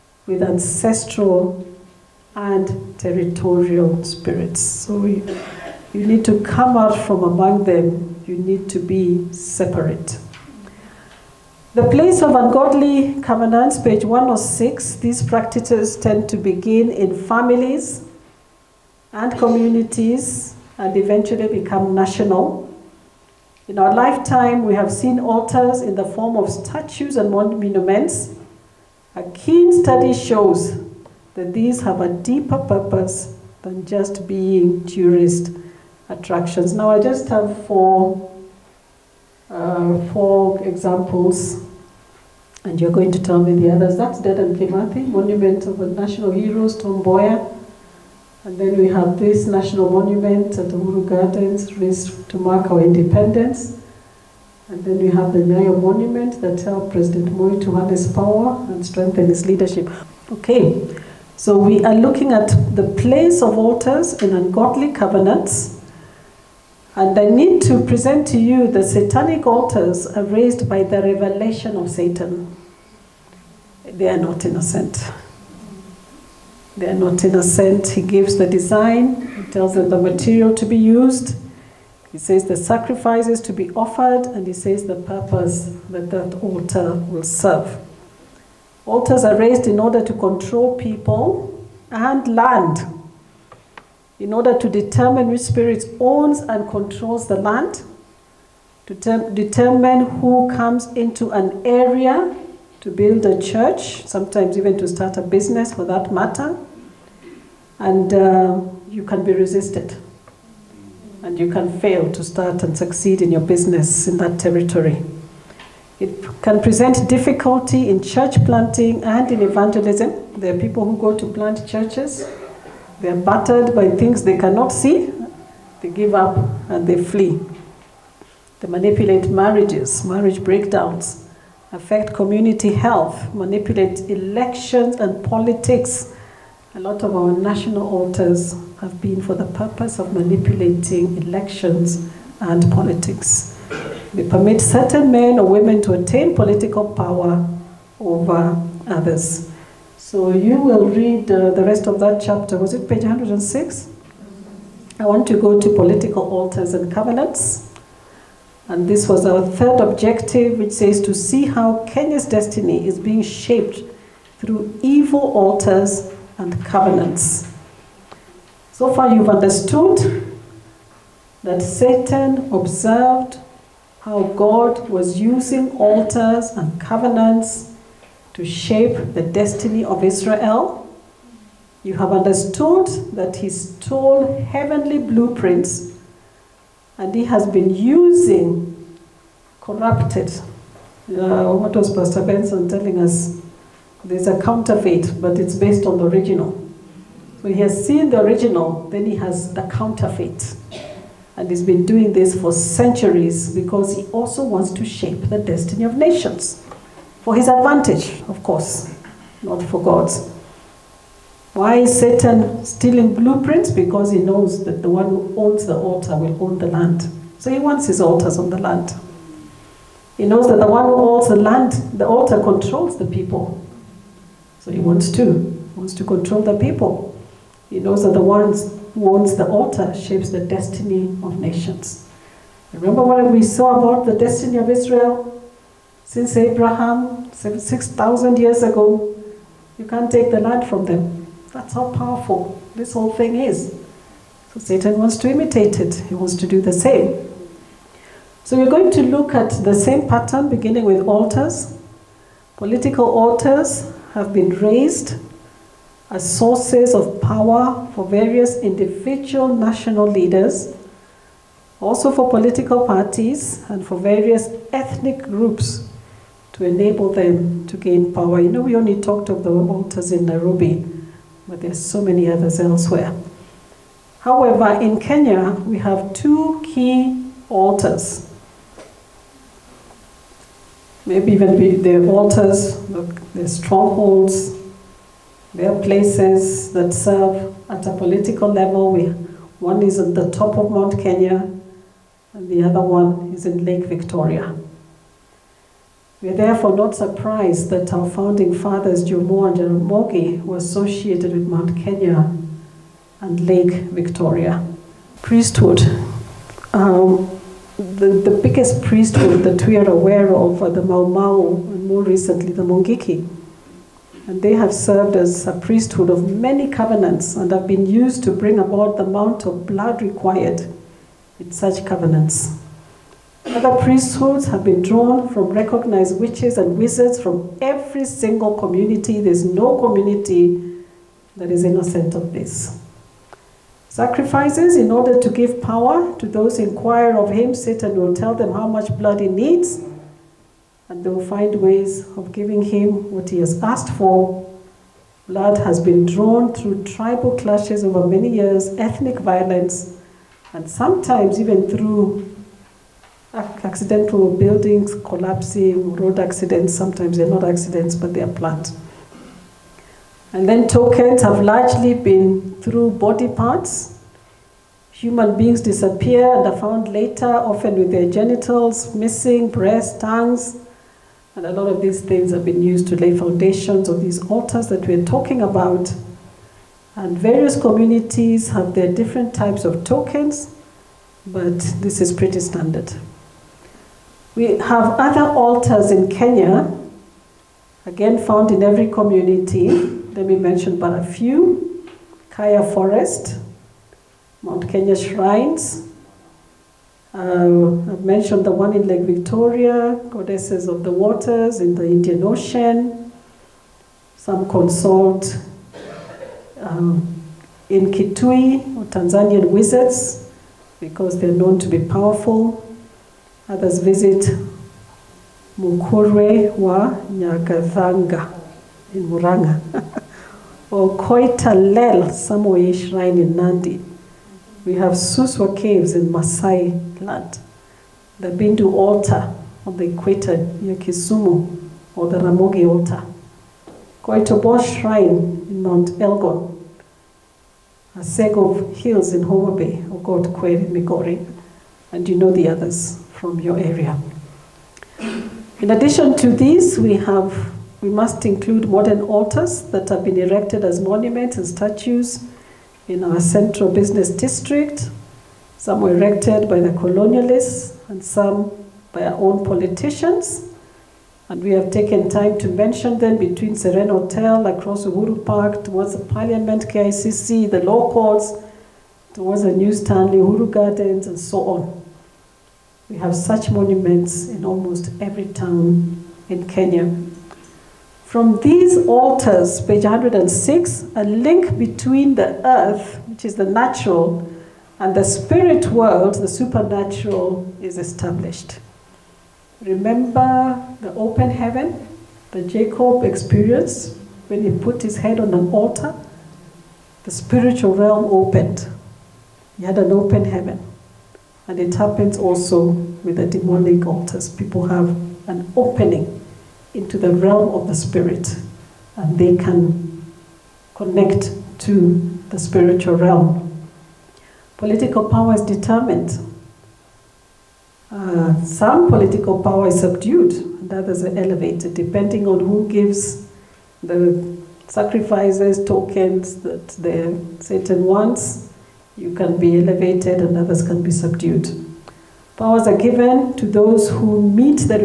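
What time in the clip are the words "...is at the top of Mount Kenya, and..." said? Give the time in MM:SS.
04:49.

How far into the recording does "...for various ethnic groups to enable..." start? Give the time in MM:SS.
04:23.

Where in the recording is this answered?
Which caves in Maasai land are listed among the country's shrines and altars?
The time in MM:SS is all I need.
07:04.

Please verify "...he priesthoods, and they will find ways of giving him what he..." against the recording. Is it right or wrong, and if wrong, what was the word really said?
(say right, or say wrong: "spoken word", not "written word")
wrong: "needs", not "priesthoods".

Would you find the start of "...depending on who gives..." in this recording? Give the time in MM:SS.
08:41.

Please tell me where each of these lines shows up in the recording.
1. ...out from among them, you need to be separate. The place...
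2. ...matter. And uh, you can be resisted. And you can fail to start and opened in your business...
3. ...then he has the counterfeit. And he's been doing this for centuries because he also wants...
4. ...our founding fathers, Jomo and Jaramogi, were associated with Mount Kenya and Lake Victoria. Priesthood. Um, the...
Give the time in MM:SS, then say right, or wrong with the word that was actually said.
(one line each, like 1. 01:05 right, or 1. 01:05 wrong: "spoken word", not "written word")
1. 00:06 right
2. 01:46 wrong: "succeed", not "opened"
3. 03:18 right
4. 04:57 right.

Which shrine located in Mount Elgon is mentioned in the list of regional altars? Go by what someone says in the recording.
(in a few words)
Koitobo Shrine.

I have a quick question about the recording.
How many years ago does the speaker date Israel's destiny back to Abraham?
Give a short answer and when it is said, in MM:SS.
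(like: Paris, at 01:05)
6,000, at 03:57.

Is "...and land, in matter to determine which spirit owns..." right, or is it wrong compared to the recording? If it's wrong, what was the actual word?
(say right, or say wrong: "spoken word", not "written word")
wrong: "order", not "matter".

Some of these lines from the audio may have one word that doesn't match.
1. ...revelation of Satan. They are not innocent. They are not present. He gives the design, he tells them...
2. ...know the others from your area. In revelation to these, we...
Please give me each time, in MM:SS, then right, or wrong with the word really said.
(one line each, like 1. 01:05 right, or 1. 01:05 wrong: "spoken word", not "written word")
1. 01:11 wrong: "innocent", not "present"
2. 07:22 wrong: "addition", not "revelation".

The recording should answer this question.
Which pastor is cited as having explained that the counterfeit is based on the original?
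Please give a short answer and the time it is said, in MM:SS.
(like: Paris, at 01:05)
Pastor Benson, at 03:11.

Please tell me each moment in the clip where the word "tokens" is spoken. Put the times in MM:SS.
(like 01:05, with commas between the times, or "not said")
06:00, 06:19, 08:45.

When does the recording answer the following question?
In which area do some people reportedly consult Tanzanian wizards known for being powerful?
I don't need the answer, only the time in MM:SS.
06:47.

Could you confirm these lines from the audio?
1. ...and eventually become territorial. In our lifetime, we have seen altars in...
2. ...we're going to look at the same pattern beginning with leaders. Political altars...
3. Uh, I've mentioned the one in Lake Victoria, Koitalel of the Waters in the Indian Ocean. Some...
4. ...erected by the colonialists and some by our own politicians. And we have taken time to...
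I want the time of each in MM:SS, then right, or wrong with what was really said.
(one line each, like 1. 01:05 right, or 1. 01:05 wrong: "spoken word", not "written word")
1. 00:20 wrong: "national", not "territorial"
2. 04:08 wrong: "altars", not "leaders"
3. 06:37 wrong: "Goddesses", not "Koitalel"
4. 07:35 right.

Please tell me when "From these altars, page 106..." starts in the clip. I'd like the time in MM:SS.
07:58.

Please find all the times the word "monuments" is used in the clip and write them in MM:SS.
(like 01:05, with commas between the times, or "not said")
00:27, 00:45, 00:49, 00:55, 07:30, 07:53.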